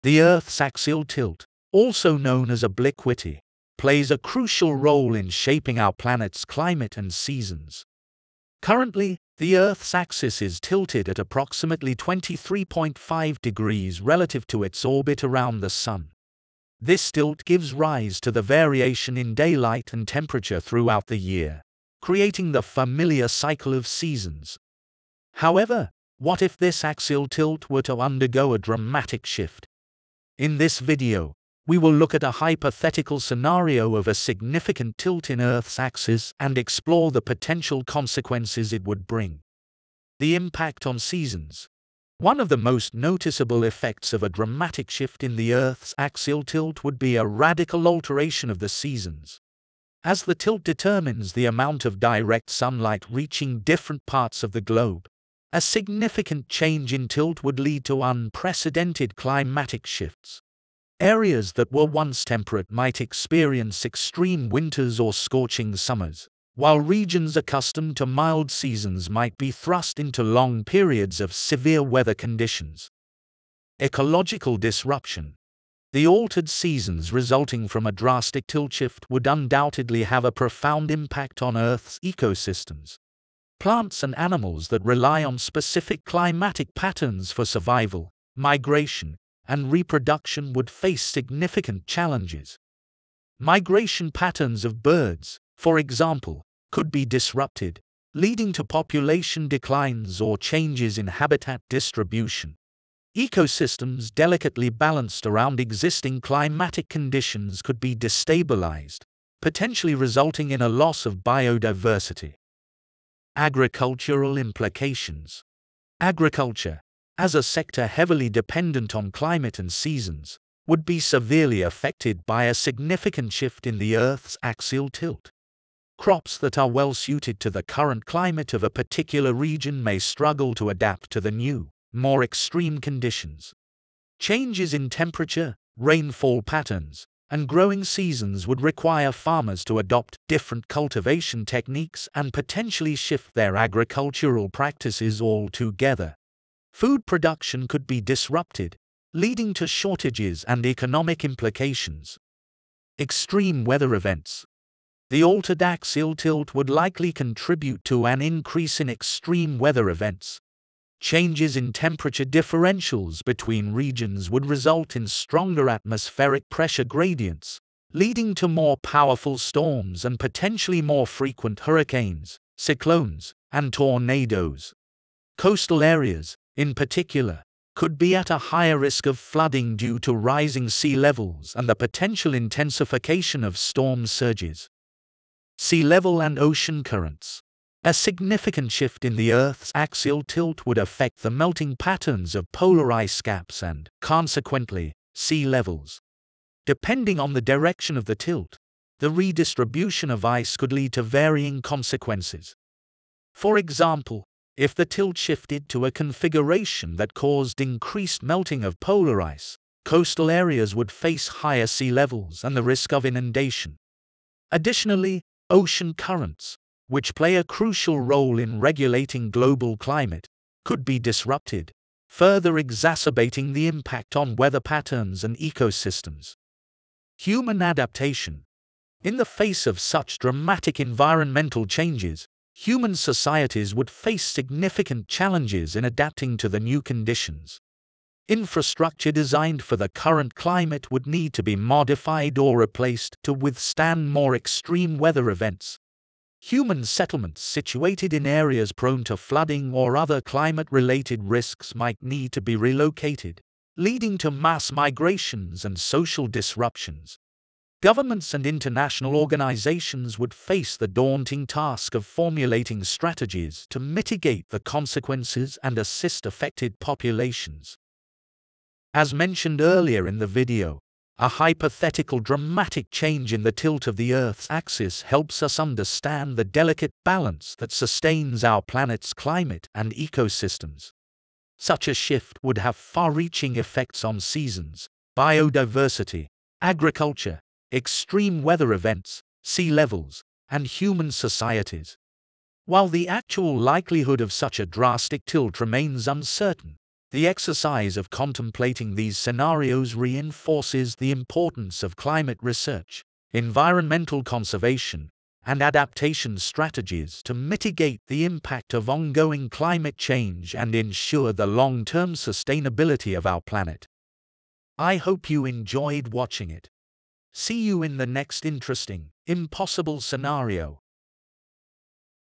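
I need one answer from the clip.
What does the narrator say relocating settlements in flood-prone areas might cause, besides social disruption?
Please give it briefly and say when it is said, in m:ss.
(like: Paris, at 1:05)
Mass migrations, at 4:14.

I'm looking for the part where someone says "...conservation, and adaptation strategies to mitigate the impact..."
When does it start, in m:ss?
5:04.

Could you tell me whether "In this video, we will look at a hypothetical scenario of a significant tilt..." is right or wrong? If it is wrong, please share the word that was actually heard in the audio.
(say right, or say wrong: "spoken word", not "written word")
right.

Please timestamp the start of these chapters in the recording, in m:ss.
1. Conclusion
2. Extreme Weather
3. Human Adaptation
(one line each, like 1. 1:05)
1. 4:29
2. 2:33
3. 3:47.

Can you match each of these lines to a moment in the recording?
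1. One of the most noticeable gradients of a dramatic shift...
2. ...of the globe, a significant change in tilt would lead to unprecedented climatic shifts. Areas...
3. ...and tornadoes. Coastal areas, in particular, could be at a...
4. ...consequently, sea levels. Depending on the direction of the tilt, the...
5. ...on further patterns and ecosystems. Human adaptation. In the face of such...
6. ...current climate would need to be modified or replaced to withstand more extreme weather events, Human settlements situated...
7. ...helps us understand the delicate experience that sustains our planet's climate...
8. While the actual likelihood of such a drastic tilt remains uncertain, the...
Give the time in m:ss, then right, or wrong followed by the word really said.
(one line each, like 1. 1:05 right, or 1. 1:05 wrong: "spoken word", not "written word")
1. 0:42 wrong: "effects", not "gradients"
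2. 0:54 right
3. 2:53 right
4. 3:14 right
5. 3:44 wrong: "weather", not "further"
6. 3:59 right
7. 4:35 wrong: "balance", not "experience"
8. 4:52 right.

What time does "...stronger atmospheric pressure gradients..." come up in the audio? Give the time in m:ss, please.
2:45.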